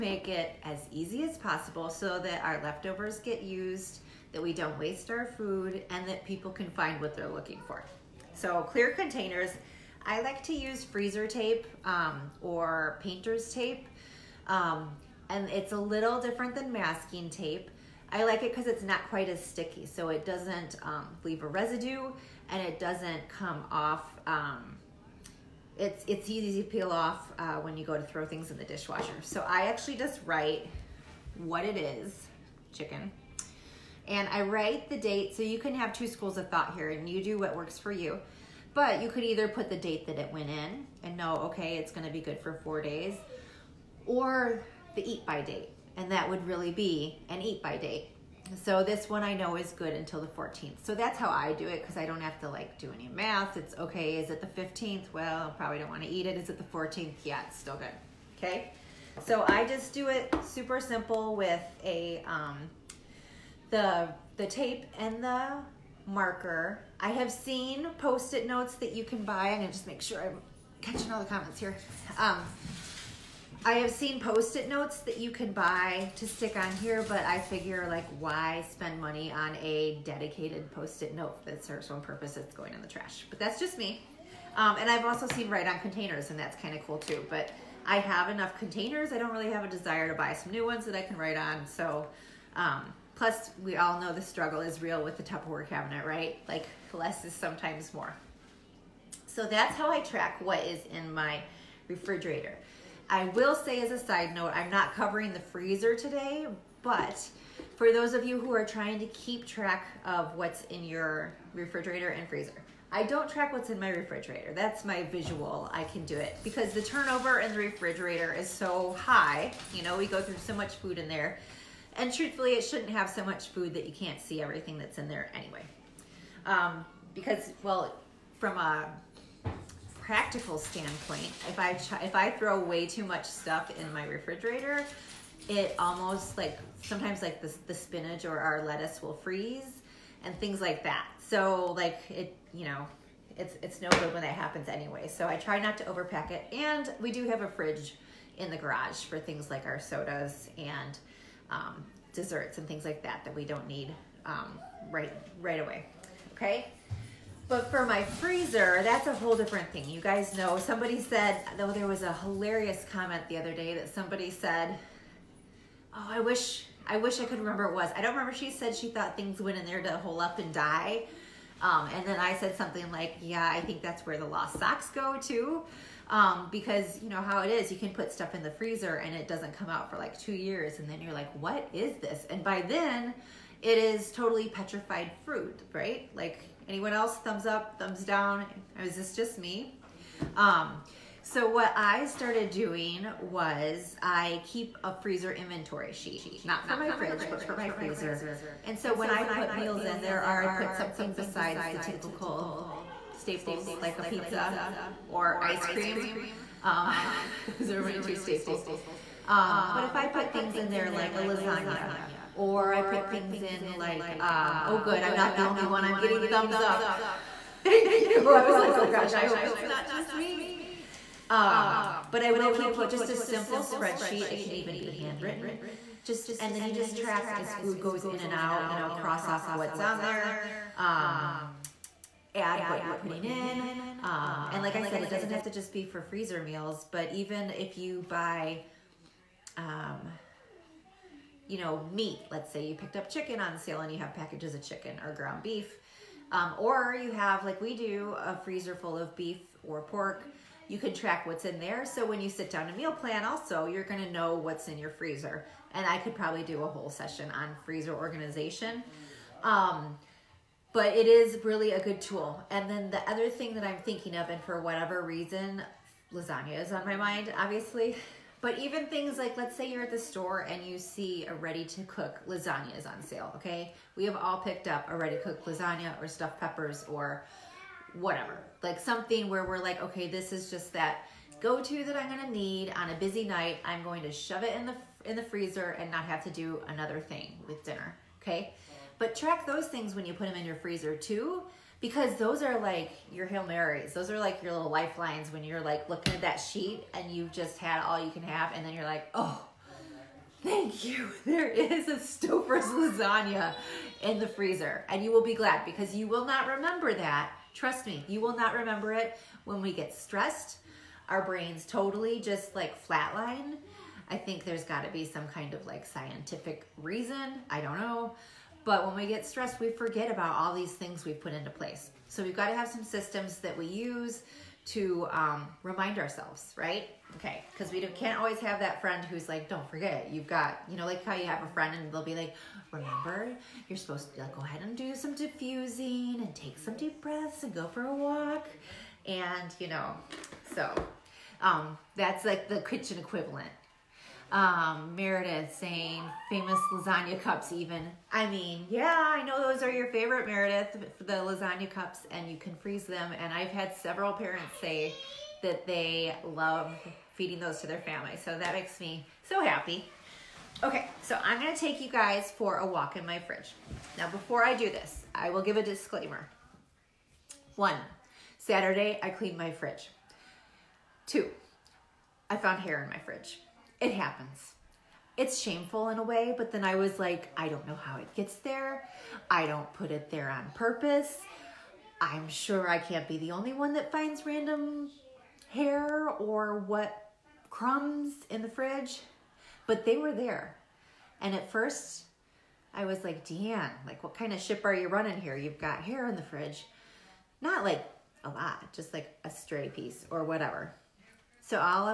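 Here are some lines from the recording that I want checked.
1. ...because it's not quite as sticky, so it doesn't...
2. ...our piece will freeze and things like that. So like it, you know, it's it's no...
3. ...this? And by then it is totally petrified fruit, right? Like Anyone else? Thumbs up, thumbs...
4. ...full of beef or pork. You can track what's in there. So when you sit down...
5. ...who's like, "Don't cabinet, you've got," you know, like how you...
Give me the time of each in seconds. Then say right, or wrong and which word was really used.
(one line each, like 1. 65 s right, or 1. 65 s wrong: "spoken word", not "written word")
1. 18 s right
2. 138 s wrong: "lettuce", not "piece"
3. 181 s right
4. 248 s right
5. 329 s wrong: "forget", not "cabinet".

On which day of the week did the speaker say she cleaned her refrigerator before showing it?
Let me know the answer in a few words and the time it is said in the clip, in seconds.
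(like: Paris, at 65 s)
Saturday, at 368 s.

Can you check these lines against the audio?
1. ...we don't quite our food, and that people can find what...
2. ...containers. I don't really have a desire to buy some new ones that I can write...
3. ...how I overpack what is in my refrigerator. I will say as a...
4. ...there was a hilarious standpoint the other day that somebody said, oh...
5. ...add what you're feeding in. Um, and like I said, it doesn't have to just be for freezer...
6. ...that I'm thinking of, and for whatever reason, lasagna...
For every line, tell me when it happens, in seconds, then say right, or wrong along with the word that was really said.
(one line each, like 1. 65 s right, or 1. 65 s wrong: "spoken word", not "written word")
1. 4 s wrong: "waste", not "quite"
2. 88 s right
3. 99 s wrong: "track", not "overpack"
4. 161 s wrong: "comment", not "standpoint"
5. 232 s wrong: "putting", not "feeding"
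6. 263 s right.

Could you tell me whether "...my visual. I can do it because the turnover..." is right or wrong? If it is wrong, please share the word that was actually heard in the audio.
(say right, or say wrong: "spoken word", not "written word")
right.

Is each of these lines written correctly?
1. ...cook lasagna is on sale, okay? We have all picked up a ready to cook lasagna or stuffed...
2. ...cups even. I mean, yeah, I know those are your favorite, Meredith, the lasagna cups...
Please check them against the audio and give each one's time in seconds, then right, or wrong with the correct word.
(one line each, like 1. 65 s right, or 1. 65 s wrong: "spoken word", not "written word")
1. 271 s right
2. 347 s right.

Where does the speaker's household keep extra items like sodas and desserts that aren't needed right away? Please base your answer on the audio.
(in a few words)
a fridge in the garage.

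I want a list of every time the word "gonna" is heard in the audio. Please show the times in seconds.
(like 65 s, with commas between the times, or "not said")
41 s, 69 s, 282 s, 361 s.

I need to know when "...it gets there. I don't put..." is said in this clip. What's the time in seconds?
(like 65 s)
377 s.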